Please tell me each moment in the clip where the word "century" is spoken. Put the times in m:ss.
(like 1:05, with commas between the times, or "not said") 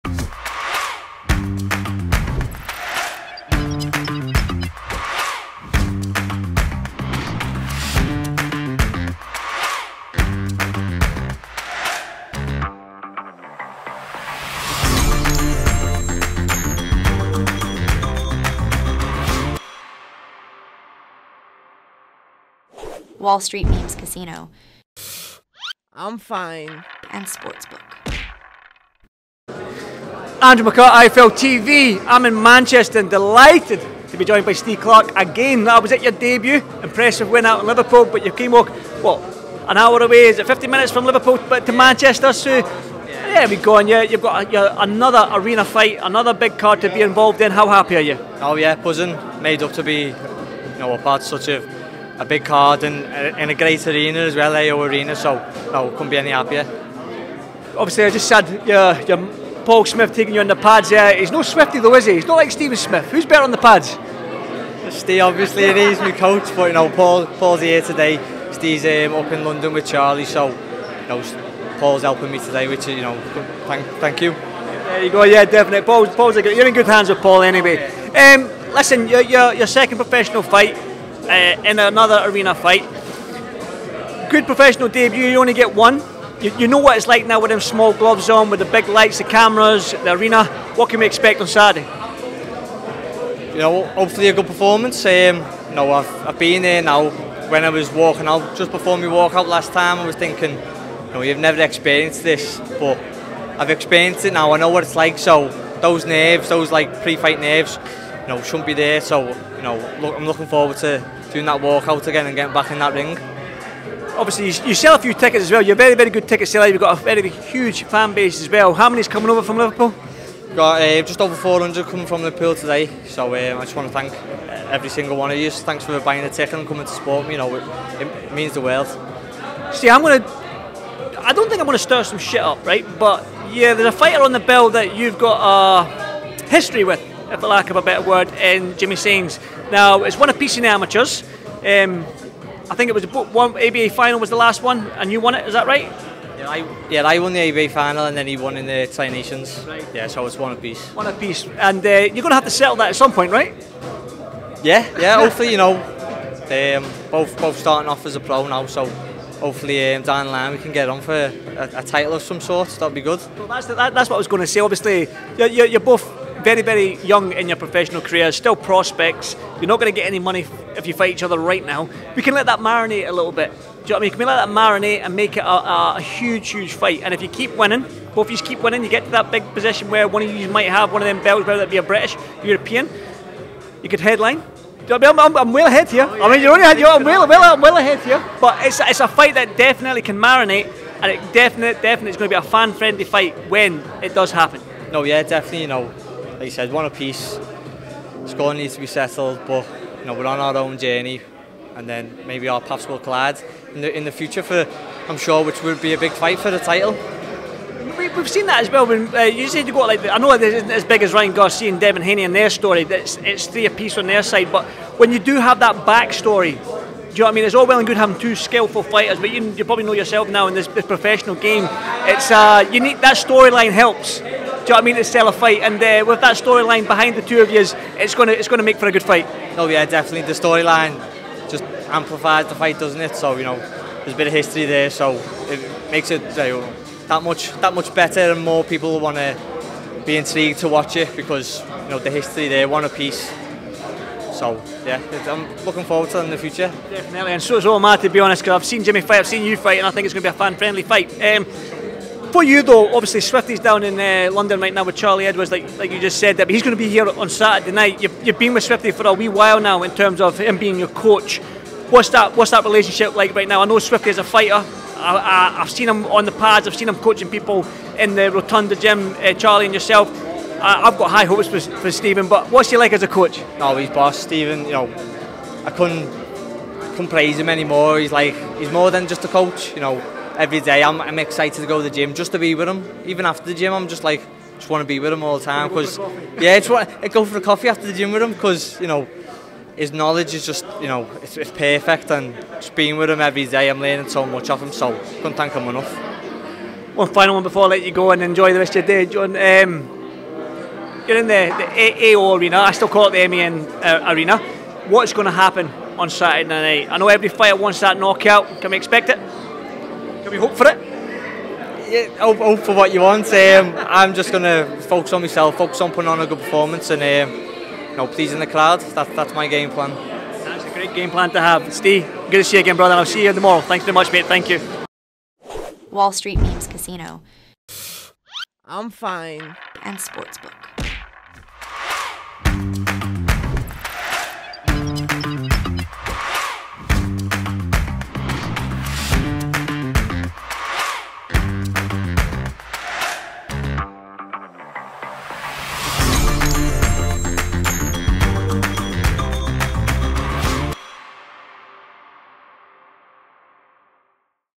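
not said.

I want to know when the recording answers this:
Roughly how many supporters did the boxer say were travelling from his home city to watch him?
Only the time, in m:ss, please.
2:01.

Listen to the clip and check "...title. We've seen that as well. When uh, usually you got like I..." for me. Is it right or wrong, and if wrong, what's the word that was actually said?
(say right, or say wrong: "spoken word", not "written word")
right.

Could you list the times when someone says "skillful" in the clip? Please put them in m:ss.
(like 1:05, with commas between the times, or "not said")
3:38.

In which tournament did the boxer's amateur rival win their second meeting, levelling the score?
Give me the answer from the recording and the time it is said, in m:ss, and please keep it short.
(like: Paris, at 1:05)
Tri Nations, at 2:28.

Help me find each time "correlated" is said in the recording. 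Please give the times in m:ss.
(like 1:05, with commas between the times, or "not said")
not said.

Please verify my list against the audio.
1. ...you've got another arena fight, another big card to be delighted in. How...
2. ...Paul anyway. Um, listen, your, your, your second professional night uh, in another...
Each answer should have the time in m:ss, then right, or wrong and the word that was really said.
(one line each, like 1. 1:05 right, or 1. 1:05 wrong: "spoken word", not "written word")
1. 0:44 wrong: "involved", not "delighted"
2. 1:17 wrong: "fight", not "night".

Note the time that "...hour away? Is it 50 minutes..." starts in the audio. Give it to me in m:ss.
0:39.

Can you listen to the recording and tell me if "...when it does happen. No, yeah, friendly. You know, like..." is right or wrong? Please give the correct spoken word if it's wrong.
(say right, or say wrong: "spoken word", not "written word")
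wrong: "definitely", not "friendly".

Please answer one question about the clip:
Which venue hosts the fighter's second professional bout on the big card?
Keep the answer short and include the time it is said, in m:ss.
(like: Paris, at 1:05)
AO Arena, at 0:54.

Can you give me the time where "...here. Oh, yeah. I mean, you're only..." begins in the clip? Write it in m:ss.
3:05.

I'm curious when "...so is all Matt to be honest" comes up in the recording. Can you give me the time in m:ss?
4:07.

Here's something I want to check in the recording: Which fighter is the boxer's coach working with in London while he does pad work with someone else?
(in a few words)
Charlie Edwards.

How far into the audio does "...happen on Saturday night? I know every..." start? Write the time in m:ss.
5:05.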